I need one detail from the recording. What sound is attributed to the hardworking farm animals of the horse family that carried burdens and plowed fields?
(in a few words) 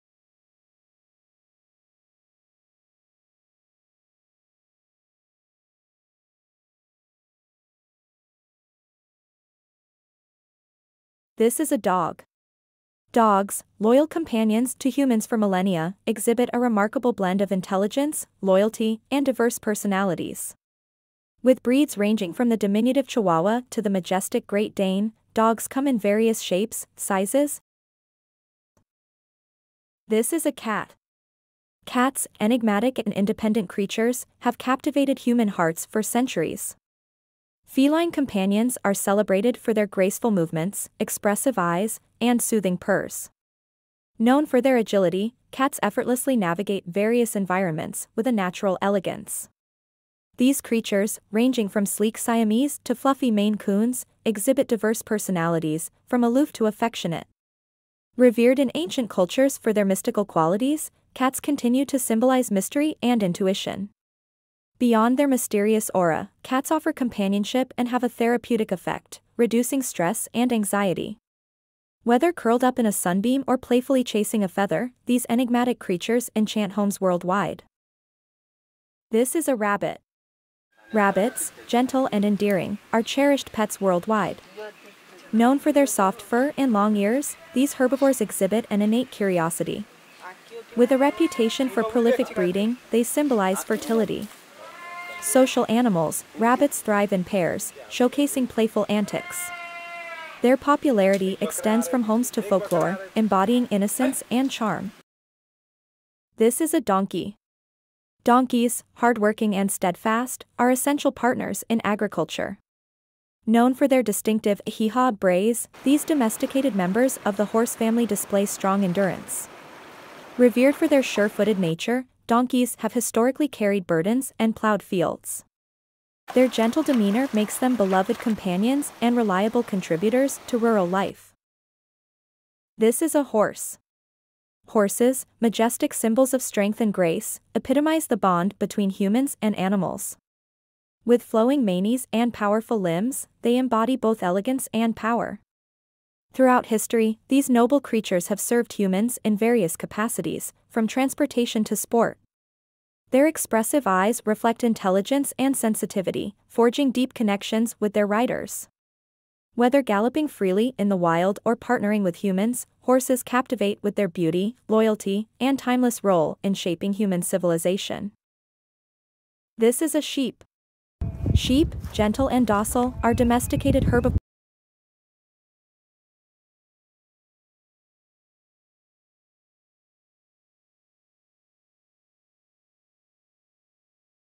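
Hee-haw brays.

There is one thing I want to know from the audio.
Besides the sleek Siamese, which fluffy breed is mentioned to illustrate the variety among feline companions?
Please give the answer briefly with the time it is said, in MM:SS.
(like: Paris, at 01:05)
Maine Coons, at 00:53.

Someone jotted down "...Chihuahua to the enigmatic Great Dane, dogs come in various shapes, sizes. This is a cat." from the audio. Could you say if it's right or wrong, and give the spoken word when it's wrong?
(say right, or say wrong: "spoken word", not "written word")
wrong: "majestic", not "enigmatic".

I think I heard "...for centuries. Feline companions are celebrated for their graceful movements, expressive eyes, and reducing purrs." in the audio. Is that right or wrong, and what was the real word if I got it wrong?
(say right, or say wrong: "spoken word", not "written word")
wrong: "soothing", not "reducing".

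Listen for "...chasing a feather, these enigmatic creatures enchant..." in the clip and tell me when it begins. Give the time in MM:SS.
01:14.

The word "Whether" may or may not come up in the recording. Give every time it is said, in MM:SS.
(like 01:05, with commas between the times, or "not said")
01:12, 02:39.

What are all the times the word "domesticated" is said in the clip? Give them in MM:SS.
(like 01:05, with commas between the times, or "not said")
01:56, 02:53.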